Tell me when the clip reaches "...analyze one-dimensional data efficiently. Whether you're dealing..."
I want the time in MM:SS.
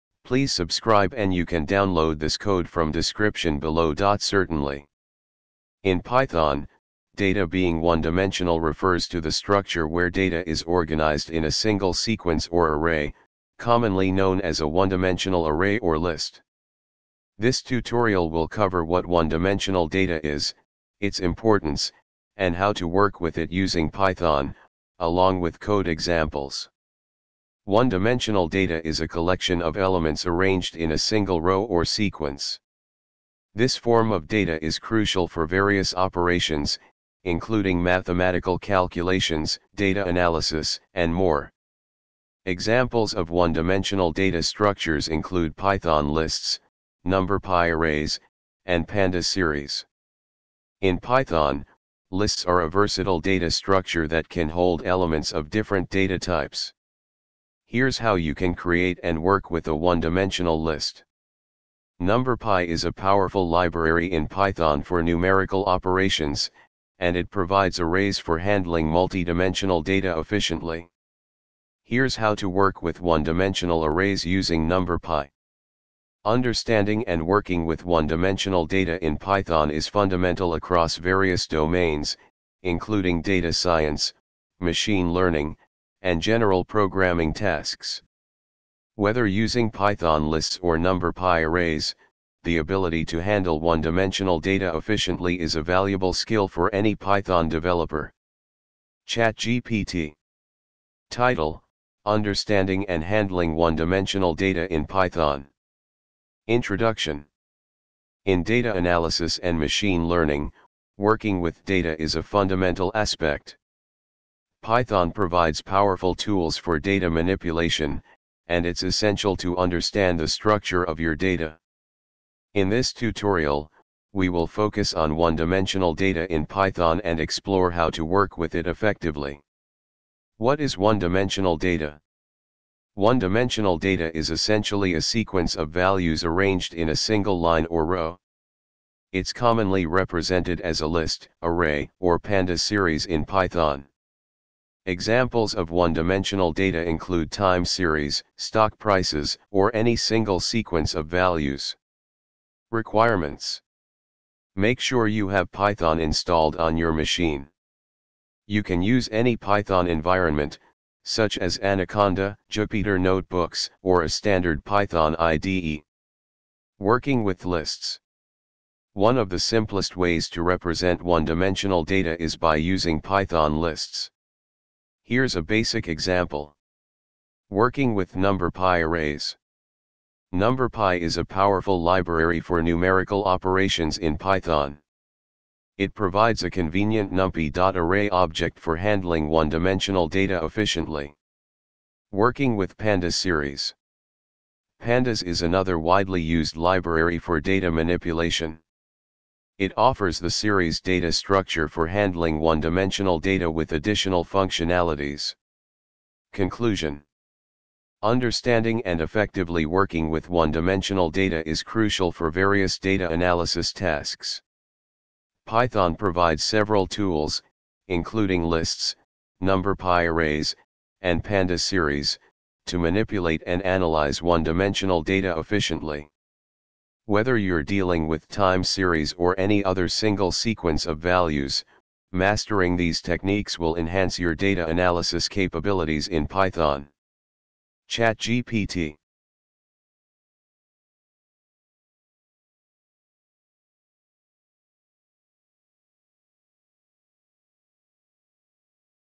03:43.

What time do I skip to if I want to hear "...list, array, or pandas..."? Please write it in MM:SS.
02:20.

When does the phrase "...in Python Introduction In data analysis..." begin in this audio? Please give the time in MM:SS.
01:44.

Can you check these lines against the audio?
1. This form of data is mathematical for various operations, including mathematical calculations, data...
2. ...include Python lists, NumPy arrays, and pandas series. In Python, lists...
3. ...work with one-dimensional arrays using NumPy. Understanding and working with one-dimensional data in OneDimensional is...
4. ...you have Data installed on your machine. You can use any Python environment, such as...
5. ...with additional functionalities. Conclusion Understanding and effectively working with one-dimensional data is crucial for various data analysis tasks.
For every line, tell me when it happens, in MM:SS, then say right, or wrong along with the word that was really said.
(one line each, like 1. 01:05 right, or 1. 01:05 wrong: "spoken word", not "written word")
1. 00:33 wrong: "crucial", not "mathematical"
2. 00:45 right
3. 01:12 wrong: "Python", not "OneDimensional"
4. 02:35 wrong: "Python", not "Data"
5. 03:23 right.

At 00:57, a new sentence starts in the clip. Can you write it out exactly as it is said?
Here's how you can create and work with a one-dimensional list.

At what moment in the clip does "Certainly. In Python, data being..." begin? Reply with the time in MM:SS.
00:04.